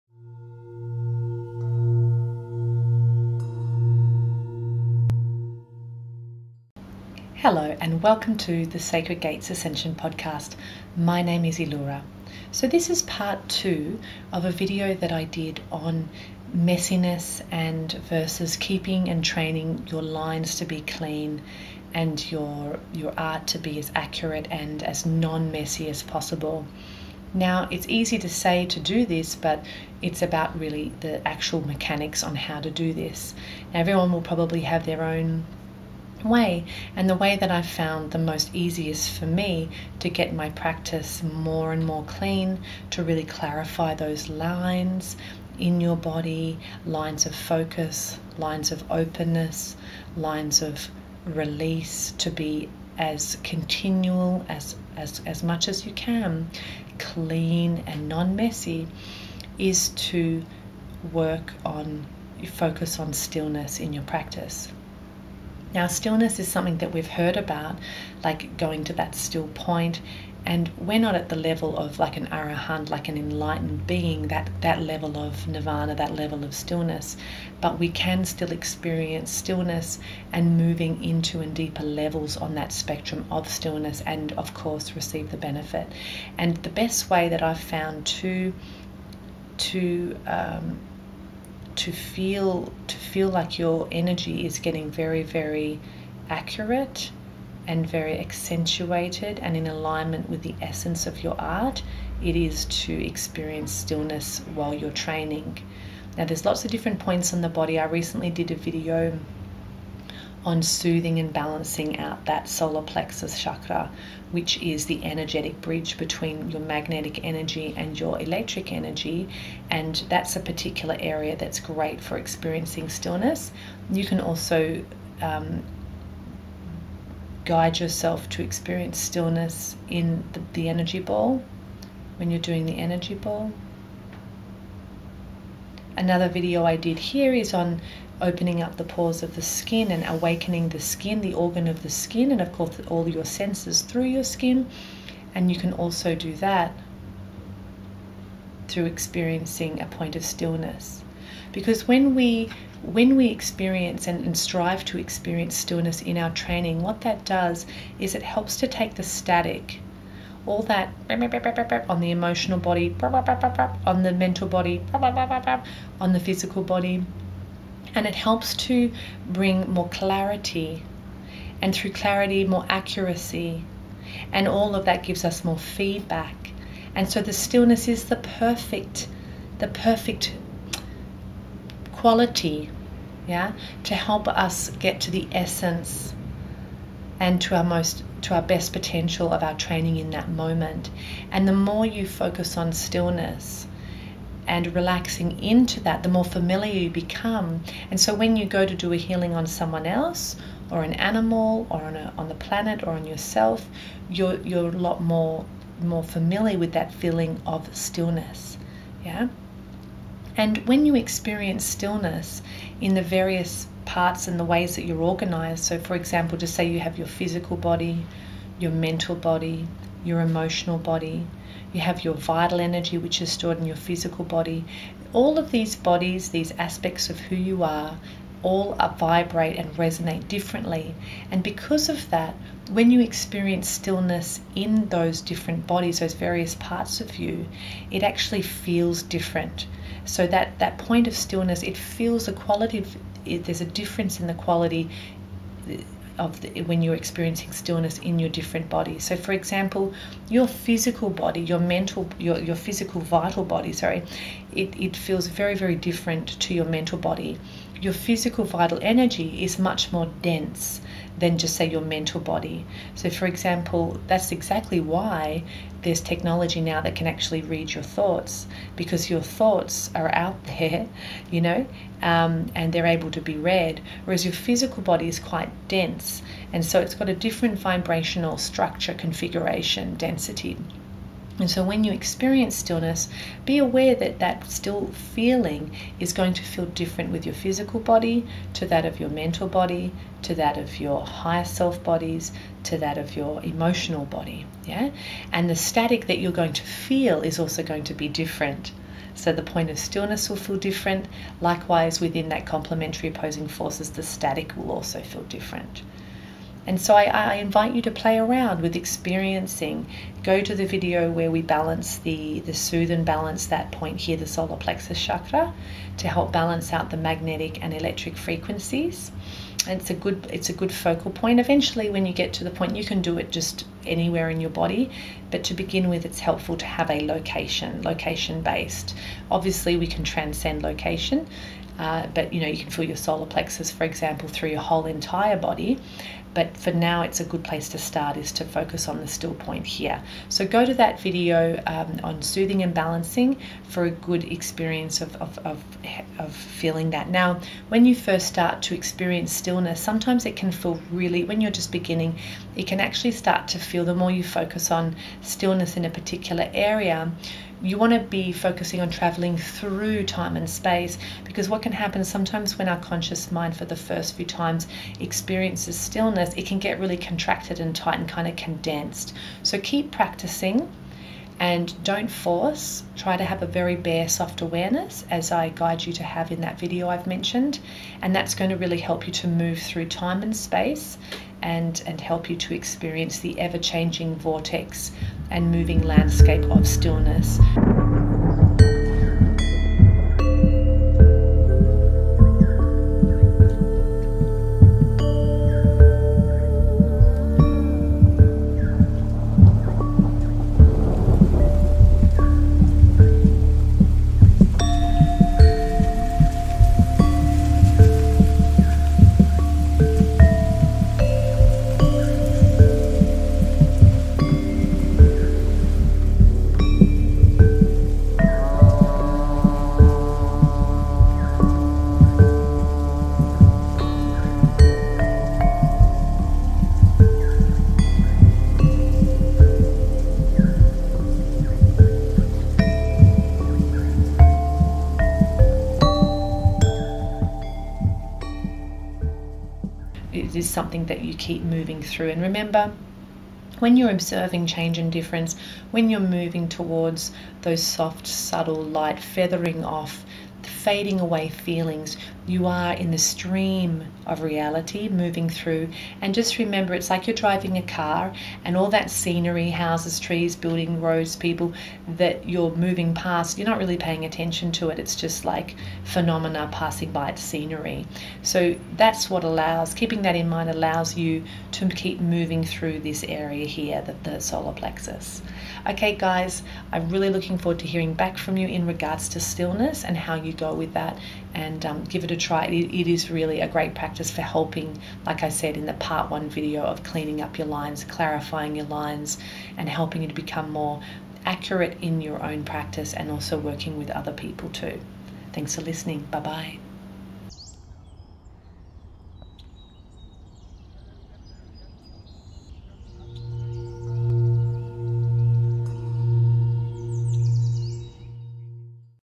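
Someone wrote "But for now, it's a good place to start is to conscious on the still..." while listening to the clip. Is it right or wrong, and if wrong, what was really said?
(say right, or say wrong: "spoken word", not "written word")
wrong: "focus", not "conscious".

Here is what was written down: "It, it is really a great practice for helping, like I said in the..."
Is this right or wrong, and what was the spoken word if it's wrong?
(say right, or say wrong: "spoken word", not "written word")
right.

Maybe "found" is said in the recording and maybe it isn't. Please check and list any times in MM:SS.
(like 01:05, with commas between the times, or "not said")
00:37, 01:27.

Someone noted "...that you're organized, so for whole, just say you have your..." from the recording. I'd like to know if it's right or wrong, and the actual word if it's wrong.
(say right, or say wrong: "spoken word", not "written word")
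wrong: "example", not "whole".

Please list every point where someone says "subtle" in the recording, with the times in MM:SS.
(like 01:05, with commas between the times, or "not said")
07:28.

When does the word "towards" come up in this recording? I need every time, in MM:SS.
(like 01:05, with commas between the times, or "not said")
07:26.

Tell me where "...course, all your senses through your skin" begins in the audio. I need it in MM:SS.
02:22.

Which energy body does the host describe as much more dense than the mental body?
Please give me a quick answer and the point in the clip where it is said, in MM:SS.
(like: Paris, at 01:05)
physical vital energy, at 04:17.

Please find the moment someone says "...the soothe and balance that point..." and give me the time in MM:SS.
05:12.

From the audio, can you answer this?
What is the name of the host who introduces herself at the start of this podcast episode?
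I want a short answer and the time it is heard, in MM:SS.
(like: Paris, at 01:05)
Illura, at 00:11.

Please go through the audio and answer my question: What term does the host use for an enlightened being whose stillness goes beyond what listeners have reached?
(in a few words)
arahant.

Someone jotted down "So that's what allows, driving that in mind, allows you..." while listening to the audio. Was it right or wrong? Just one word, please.
wrong.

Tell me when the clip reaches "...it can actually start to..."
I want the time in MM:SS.
05:52.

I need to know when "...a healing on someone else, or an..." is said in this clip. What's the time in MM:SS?
03:18.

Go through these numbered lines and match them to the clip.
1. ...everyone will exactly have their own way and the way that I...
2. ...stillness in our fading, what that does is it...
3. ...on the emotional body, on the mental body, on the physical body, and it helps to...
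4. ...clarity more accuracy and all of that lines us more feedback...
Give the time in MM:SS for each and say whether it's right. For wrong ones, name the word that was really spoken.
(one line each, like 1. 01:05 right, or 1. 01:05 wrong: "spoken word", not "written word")
1. 00:33 wrong: "probably", not "exactly"
2. 02:35 wrong: "training", not "fading"
3. 02:41 right
4. 02:51 wrong: "gives", not "lines".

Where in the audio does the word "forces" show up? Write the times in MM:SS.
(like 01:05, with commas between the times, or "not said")
05:03, 06:12.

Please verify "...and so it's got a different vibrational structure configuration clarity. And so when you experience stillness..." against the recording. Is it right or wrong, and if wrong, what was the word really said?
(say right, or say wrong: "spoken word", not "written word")
wrong: "density", not "clarity".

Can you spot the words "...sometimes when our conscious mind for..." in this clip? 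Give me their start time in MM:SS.
06:02.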